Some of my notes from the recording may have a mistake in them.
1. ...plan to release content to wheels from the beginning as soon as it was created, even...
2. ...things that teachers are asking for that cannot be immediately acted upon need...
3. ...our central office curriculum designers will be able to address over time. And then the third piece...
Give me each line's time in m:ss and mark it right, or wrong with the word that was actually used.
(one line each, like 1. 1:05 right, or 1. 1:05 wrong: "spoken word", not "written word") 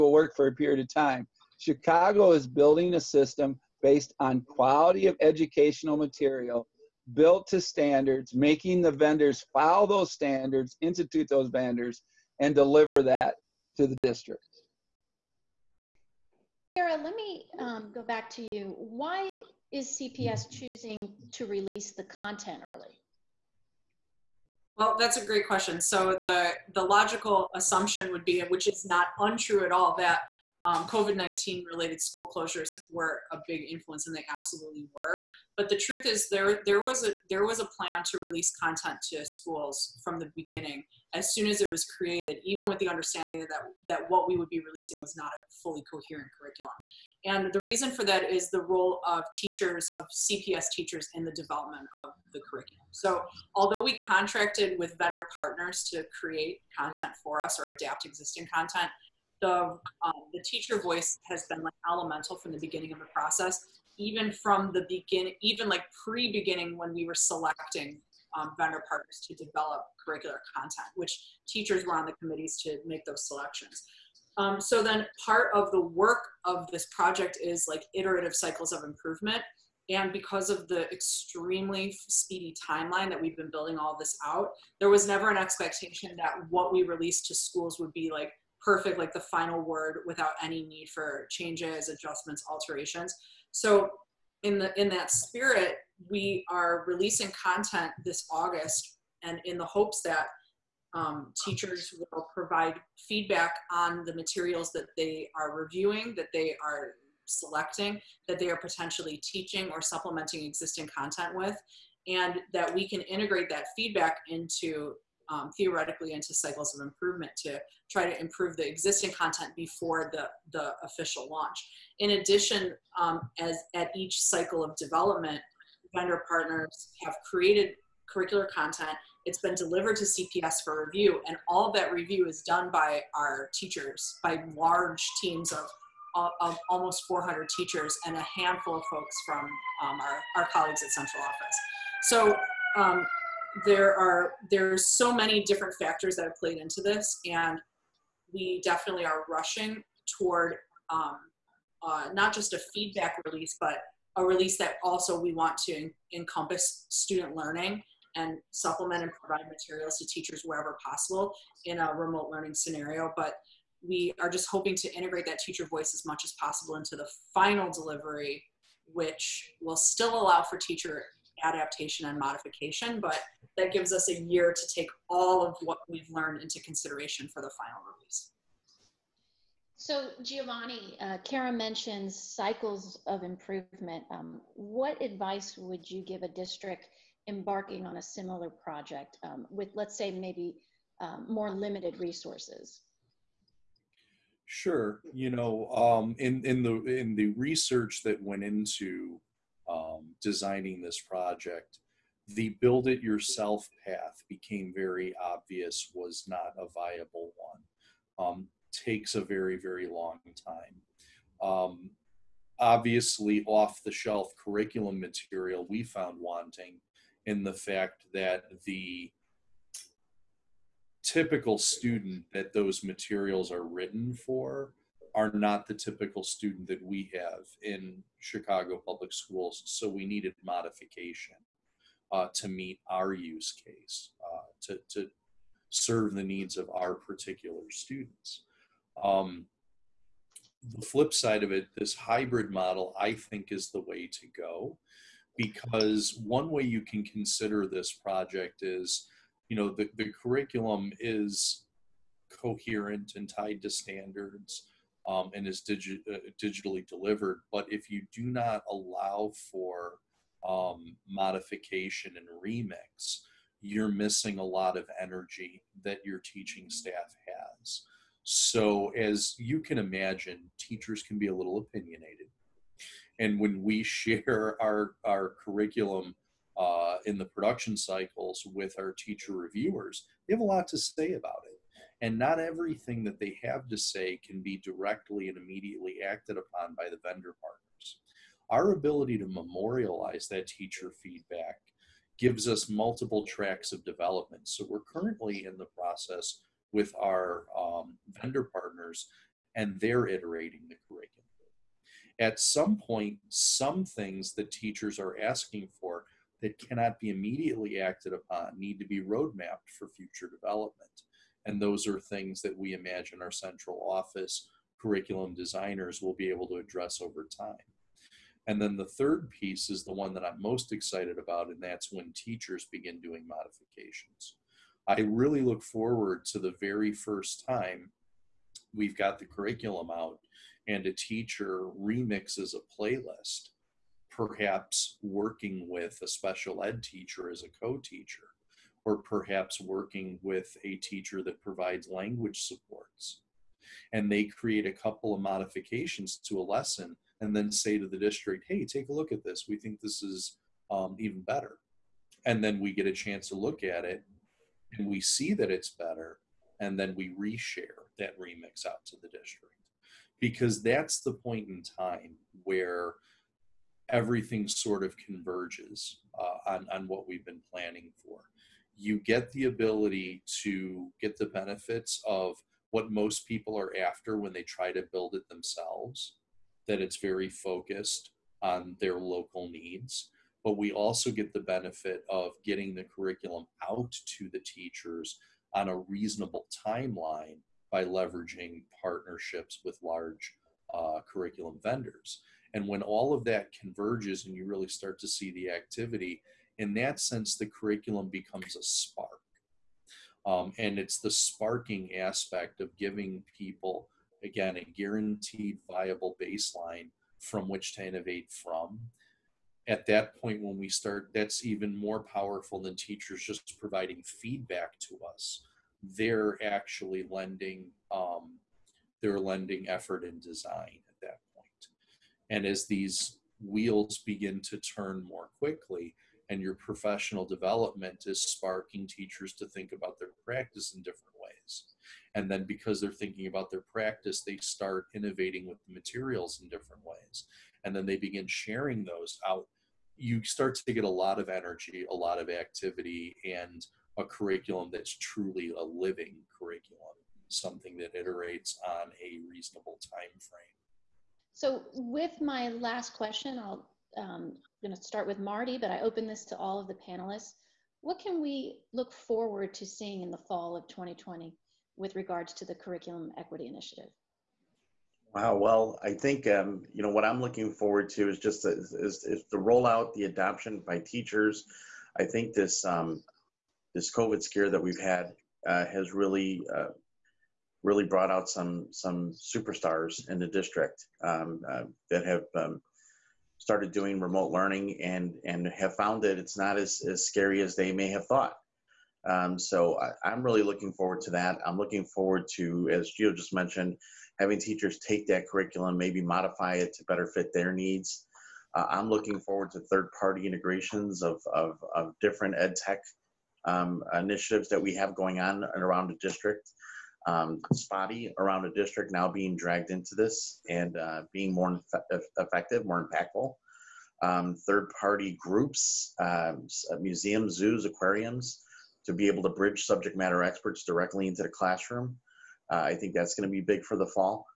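1. 0:37 wrong: "schools", not "wheels"
2. 5:03 right
3. 5:13 right.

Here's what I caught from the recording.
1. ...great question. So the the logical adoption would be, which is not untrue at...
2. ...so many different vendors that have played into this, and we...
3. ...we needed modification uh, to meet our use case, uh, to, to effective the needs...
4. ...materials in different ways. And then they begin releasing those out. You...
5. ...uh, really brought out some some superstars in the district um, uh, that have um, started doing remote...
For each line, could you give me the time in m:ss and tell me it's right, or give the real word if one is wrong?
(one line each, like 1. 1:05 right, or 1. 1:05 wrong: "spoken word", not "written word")
1. 0:25 wrong: "assumption", not "adoption"
2. 2:24 wrong: "factors", not "vendors"
3. 3:49 wrong: "serve", not "effective"
4. 7:15 wrong: "sharing", not "releasing"
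5. 7:56 right.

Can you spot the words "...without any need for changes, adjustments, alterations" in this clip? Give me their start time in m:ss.
1:30.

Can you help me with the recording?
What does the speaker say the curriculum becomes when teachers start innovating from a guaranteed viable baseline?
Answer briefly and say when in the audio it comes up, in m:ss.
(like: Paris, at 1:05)
a spark, at 6:38.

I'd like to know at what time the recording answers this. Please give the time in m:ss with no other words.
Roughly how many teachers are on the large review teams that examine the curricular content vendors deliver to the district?
2:16.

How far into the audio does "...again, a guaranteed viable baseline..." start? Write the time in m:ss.
6:44.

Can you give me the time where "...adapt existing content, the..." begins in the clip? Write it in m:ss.
0:57.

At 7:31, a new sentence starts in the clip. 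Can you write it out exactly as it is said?
So, with my last question, I'll um, I'm going to start with Marty, but I open this to all of the panelists.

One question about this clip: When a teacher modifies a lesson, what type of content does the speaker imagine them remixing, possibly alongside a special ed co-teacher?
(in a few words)
a playlist.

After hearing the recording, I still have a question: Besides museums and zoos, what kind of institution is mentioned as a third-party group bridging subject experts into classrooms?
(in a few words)
aquariums.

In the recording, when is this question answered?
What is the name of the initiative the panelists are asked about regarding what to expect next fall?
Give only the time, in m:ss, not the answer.
7:42.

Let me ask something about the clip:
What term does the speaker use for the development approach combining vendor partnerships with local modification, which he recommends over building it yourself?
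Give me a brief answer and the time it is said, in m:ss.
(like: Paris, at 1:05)
hybrid model, at 4:01.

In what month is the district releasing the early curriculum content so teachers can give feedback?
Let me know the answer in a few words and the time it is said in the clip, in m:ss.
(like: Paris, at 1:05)
August, at 1:38.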